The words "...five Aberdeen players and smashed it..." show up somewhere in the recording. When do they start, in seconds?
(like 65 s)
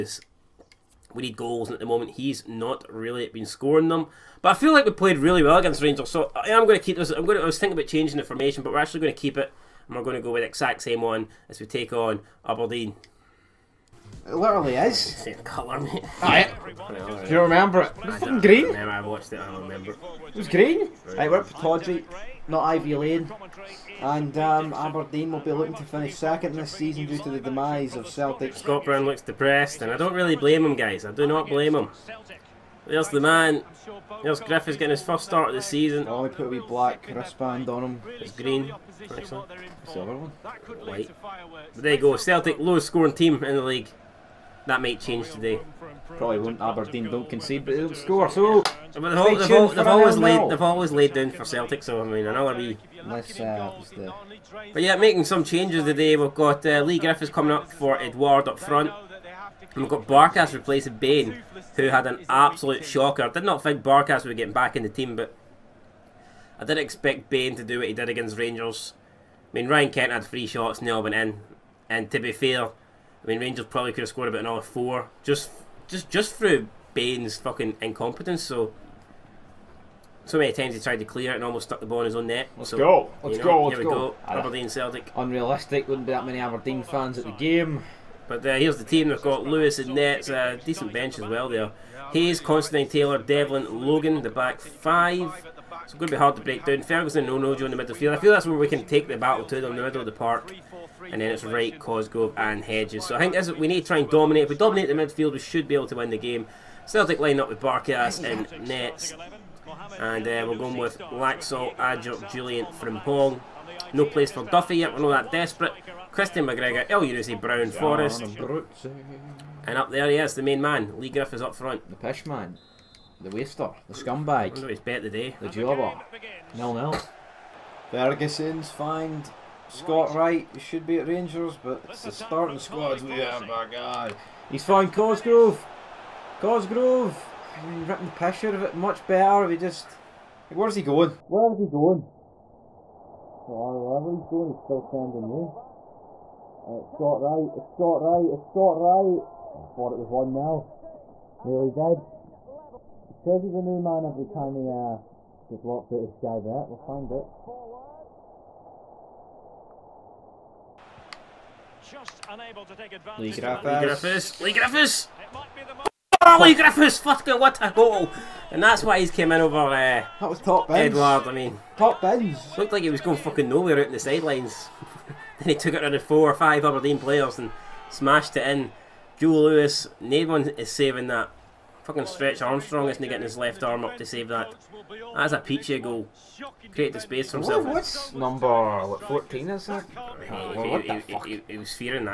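176 s.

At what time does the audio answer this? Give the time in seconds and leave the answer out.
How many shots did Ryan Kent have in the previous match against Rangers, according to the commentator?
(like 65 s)
70 s.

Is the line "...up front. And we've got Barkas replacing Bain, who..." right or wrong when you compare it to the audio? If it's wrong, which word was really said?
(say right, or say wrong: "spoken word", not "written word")
right.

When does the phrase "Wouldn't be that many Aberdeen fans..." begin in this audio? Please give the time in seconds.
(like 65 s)
85 s.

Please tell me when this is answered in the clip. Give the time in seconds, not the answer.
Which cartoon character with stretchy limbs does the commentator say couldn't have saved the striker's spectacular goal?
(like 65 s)
182 s.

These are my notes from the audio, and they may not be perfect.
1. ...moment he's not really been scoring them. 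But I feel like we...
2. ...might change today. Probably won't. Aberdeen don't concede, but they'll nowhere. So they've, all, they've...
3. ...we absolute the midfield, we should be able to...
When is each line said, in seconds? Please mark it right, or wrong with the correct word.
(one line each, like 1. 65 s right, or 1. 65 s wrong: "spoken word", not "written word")
1. 1 s right
2. 44 s wrong: "score", not "nowhere"
3. 104 s wrong: "dominate", not "absolute".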